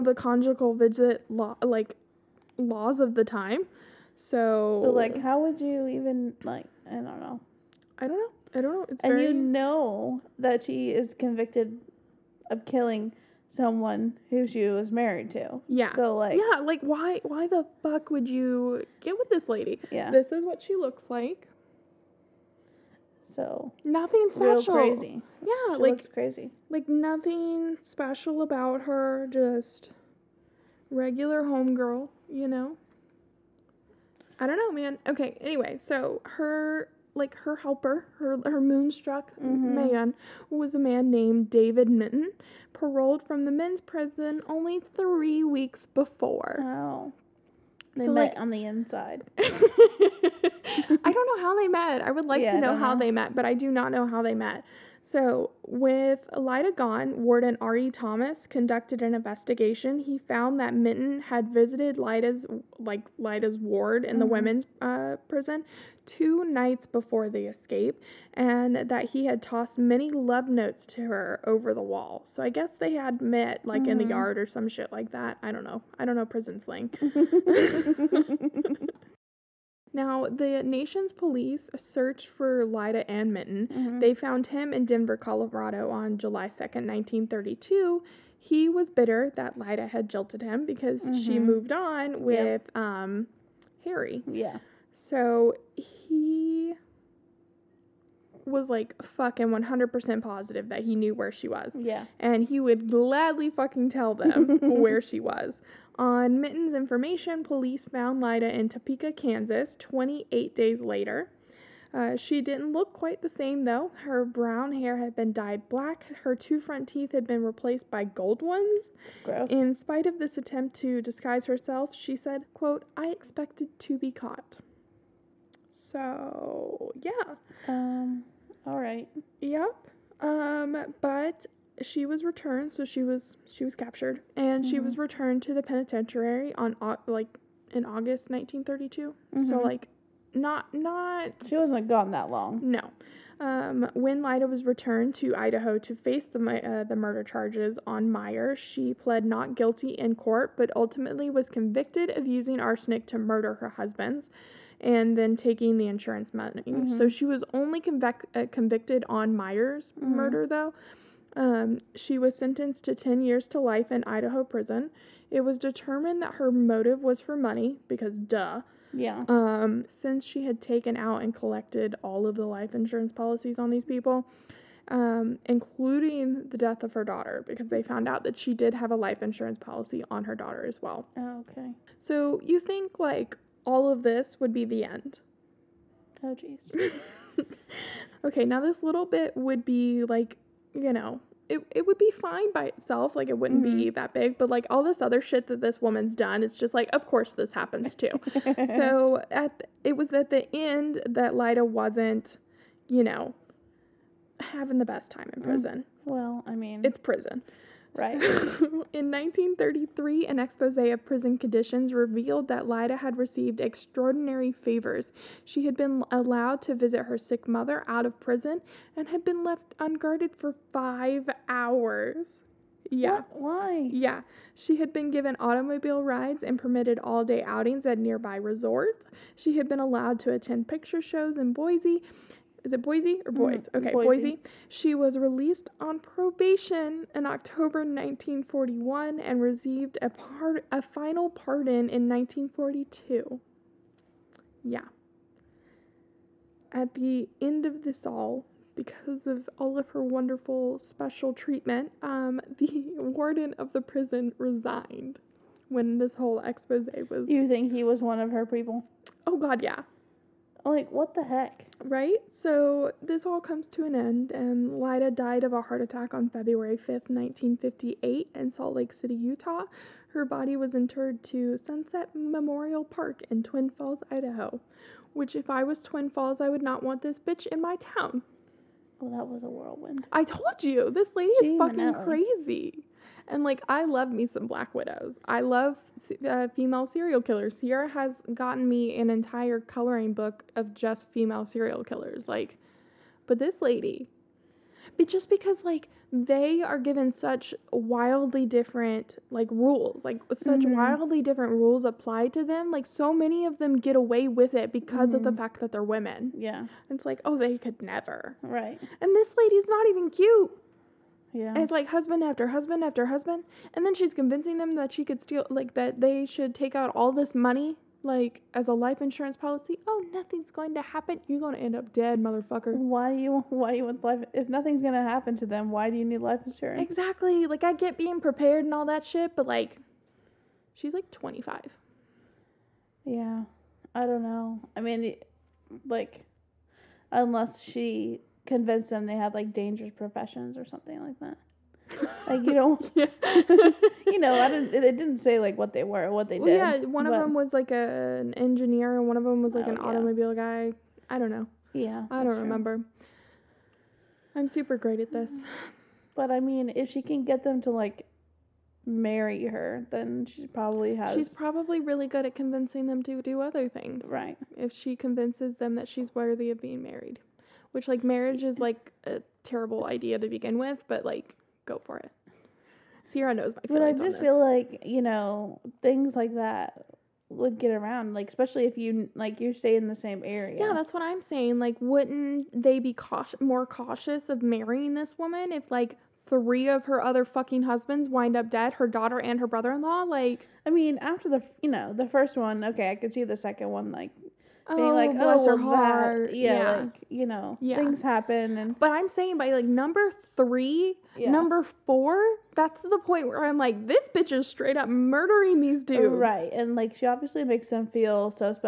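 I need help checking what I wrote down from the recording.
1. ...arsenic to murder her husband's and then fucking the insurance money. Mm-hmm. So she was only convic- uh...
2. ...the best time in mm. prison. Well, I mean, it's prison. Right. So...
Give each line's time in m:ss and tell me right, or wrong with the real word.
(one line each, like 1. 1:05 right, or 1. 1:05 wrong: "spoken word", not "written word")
1. 2:32 wrong: "taking", not "fucking"
2. 3:24 right.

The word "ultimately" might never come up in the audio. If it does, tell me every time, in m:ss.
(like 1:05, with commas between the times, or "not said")
2:30.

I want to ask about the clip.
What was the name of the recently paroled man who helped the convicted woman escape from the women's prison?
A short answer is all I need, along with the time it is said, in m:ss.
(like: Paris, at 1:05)
David Minton, at 0:41.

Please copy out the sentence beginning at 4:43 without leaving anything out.
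And like, I love me some Black Widows.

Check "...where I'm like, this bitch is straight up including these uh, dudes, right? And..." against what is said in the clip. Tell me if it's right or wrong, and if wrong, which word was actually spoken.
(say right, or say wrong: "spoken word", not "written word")
wrong: "murdering", not "including".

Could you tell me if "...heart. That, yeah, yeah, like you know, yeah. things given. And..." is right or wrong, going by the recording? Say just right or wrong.
wrong.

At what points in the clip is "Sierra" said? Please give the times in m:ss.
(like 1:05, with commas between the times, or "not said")
4:47, 6:13.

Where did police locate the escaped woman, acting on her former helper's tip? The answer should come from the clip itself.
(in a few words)
Topeka, Kansas.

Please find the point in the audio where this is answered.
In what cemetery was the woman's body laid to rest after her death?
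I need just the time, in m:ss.
4:31.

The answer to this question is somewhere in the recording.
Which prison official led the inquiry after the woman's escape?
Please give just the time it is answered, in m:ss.
0:57.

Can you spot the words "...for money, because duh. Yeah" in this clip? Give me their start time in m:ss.
2:47.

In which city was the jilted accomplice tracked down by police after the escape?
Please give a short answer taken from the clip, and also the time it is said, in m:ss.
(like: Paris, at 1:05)
Denver, at 1:24.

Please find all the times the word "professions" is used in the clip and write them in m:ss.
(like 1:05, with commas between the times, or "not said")
5:39.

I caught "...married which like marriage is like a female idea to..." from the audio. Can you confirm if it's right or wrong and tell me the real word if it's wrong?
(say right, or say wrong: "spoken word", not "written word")
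wrong: "terrible", not "female".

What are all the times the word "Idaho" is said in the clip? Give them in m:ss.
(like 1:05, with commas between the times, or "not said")
2:25, 2:44, 4:34.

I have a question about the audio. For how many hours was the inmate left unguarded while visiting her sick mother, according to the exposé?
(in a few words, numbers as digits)
5.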